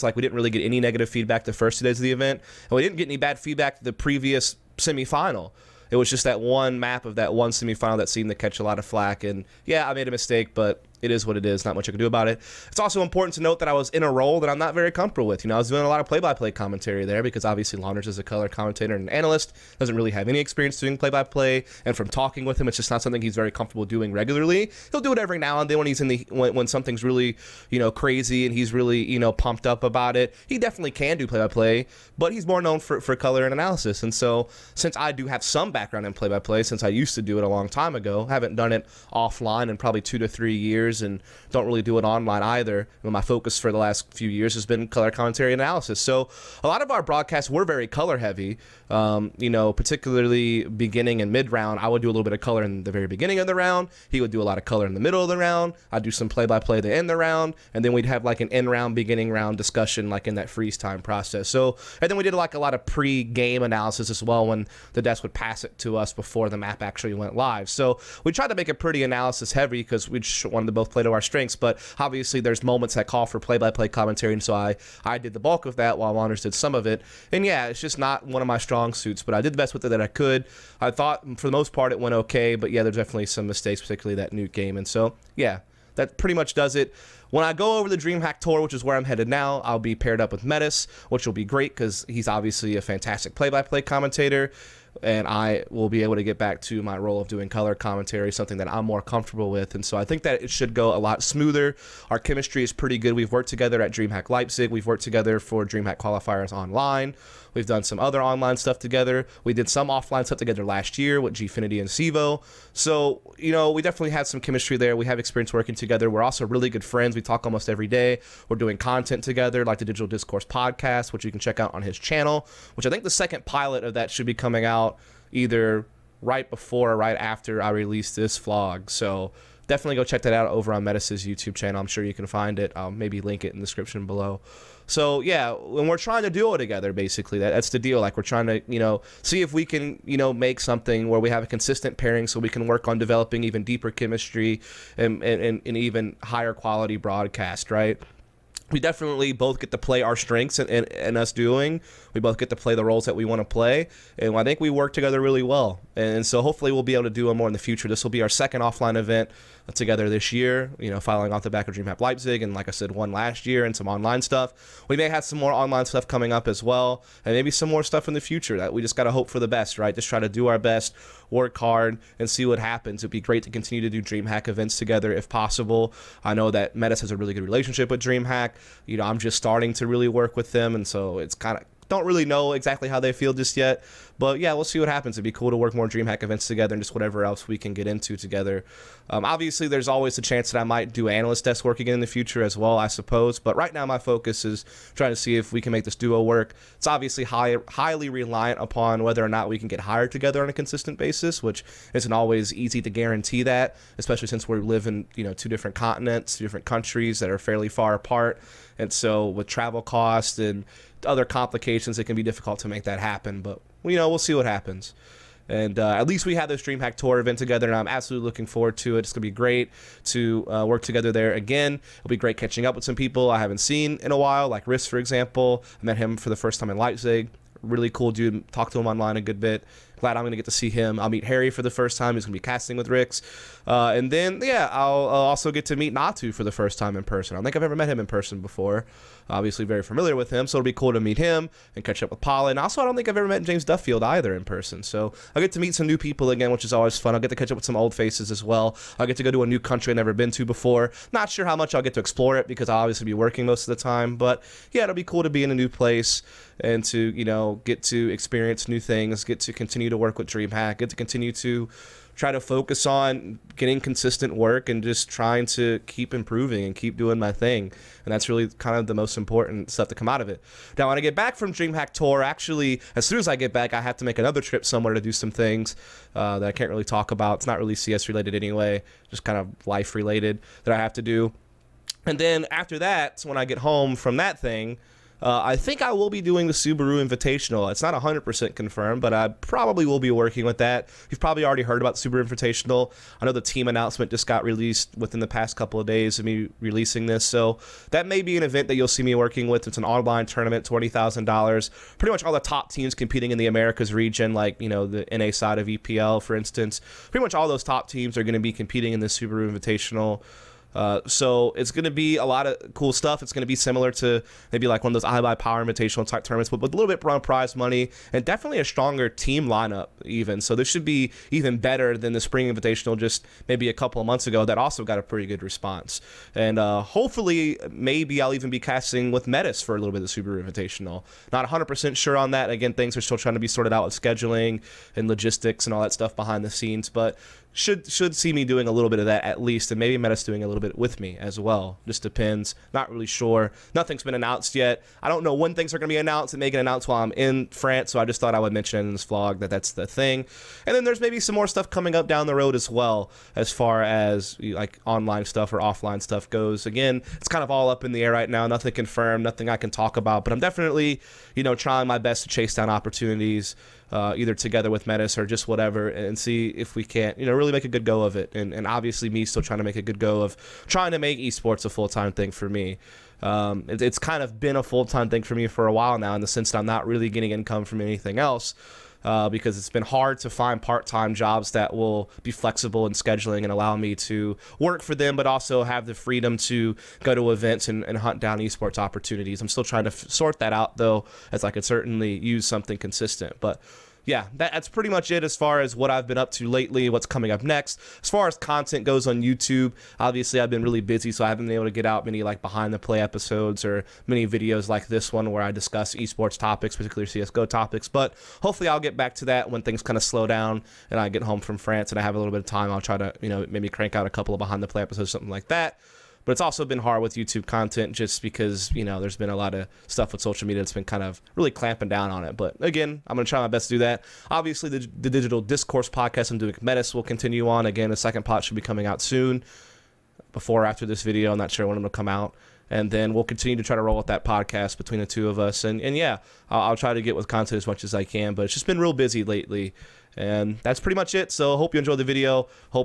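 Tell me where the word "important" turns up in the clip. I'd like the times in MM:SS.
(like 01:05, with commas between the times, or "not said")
00:13, 04:29.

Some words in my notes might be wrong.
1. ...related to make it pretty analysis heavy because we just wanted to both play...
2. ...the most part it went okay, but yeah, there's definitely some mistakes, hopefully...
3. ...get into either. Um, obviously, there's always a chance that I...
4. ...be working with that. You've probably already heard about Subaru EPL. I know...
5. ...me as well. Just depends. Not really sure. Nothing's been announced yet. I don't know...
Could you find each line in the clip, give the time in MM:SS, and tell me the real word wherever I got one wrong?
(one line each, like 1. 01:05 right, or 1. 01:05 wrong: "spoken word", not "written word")
1. 01:08 wrong: "tried", not "related"
2. 01:21 wrong: "particularly", not "hopefully"
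3. 03:07 wrong: "together", not "either"
4. 04:50 wrong: "Invitational", not "EPL"
5. 05:40 right.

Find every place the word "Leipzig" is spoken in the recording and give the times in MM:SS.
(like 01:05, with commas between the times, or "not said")
01:44, 02:42, 03:46.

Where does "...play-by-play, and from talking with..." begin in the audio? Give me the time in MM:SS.
00:20.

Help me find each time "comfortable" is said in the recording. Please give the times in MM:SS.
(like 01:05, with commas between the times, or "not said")
00:14, 00:23, 01:39.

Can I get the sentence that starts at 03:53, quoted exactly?
Uh, and then, yeah, I'll, I'll also get to meet Natu for the first time in person.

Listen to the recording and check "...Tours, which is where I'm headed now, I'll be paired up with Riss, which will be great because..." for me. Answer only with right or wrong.
wrong.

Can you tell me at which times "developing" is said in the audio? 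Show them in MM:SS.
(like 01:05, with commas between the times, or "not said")
02:22.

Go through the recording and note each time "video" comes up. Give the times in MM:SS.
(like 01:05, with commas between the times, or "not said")
06:44, 07:11, 07:22.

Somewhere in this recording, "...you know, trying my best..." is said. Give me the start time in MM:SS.
06:01.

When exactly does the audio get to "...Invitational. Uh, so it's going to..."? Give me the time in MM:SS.
05:09.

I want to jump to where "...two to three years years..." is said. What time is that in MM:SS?
00:39.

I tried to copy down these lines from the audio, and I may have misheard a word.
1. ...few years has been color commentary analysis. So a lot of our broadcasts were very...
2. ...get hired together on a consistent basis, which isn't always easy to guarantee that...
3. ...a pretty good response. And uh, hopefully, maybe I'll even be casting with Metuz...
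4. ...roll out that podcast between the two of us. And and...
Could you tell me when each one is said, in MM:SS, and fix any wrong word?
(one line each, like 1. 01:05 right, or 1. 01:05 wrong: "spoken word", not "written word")
1. 00:44 right
2. 03:19 right
3. 05:24 right
4. 07:13 right.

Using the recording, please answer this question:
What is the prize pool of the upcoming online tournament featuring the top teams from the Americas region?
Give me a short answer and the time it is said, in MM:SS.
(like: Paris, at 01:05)
$20,000, at 05:00.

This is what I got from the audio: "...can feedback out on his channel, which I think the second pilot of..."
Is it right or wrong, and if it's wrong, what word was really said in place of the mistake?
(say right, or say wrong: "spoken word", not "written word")
wrong: "check", not "feedback".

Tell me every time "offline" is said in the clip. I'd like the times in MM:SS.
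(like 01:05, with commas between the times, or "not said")
00:39, 01:49, 02:38, 05:55.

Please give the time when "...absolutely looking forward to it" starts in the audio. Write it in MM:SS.
03:37.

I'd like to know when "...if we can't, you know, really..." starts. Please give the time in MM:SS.
06:06.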